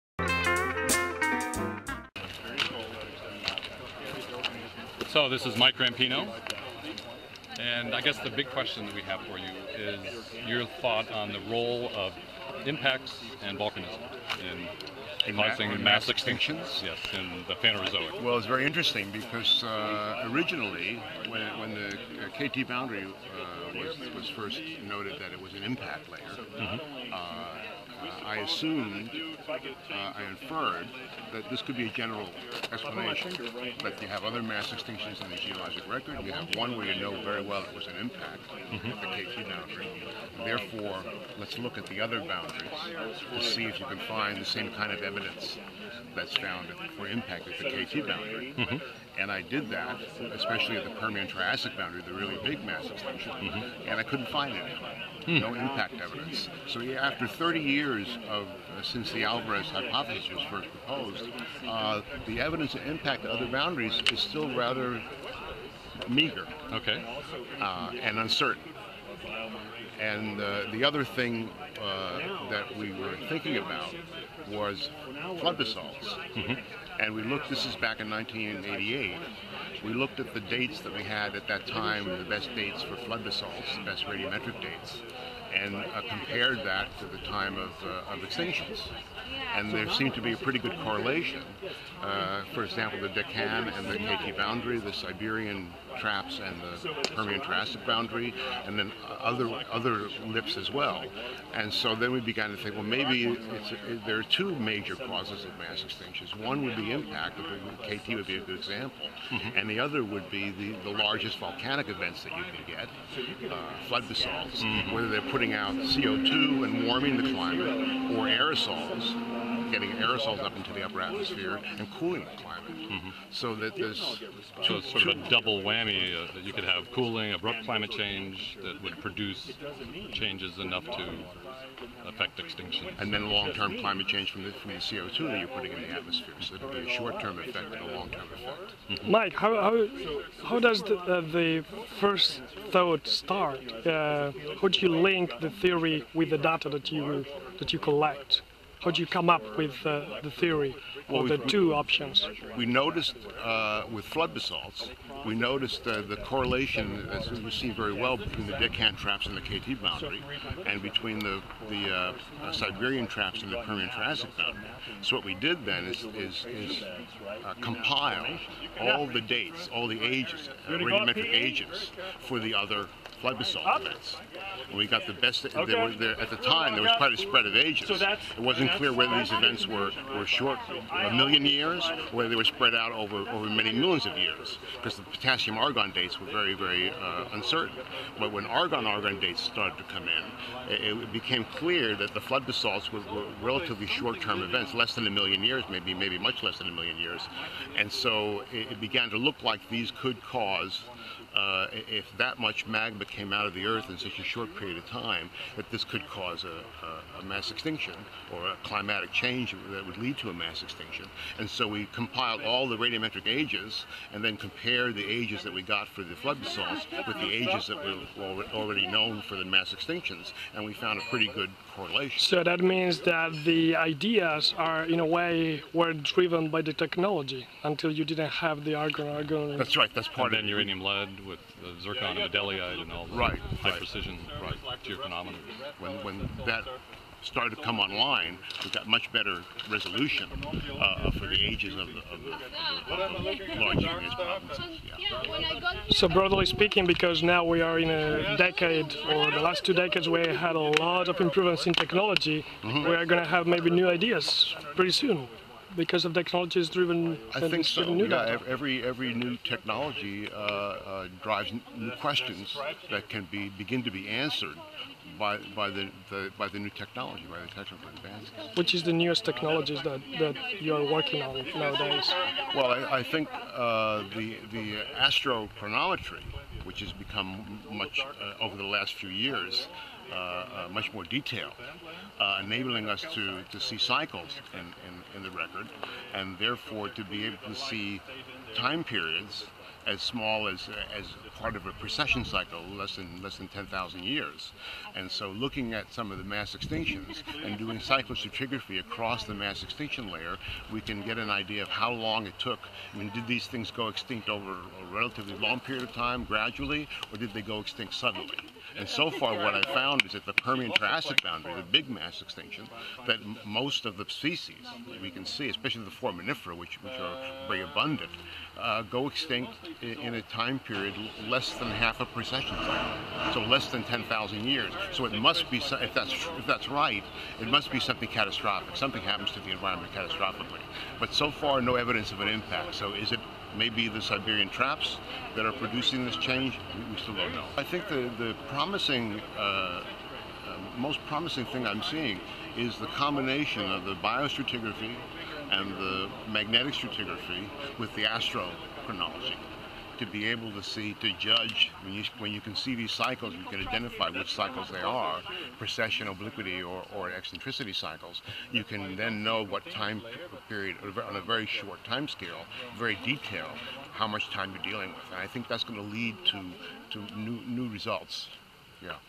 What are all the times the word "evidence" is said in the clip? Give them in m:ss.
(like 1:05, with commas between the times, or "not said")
0:45, 0:56, 1:02, 5:31.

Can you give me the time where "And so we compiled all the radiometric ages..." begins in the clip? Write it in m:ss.
3:31.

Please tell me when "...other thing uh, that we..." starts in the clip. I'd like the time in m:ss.
1:10.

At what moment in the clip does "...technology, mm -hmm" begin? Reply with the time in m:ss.
4:11.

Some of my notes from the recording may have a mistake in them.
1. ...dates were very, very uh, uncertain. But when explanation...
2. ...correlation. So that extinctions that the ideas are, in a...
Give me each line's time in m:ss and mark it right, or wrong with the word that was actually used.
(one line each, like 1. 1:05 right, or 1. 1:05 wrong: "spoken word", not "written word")
1. 3:05 wrong: "argon", not "explanation"
2. 3:41 wrong: "means", not "extinctions".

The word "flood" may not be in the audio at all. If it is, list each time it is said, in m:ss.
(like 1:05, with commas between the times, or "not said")
1:15, 1:22, 1:53, 2:34, 2:53, 3:12, 3:36.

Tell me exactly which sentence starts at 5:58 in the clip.
You can then know what time period, on a very short time scale, very detailed, how much time you're dealing with.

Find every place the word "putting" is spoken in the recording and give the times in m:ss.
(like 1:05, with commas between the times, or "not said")
1:55, 2:15.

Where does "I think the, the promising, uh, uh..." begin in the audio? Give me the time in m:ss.
5:37.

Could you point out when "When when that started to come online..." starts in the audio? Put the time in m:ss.
3:55.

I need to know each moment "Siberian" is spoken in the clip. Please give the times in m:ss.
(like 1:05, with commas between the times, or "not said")
1:34, 2:42, 5:34.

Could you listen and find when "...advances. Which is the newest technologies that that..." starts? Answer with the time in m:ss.
4:27.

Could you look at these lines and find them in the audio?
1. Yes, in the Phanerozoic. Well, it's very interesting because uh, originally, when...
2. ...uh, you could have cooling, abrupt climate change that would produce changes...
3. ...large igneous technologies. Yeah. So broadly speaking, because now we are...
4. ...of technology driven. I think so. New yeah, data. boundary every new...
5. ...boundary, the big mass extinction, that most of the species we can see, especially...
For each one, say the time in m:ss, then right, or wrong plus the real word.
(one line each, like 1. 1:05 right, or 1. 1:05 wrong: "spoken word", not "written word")
1. 0:16 right
2. 2:06 right
3. 4:03 wrong: "provinces", not "technologies"
4. 4:16 wrong: "every", not "boundary"
5. 5:11 right.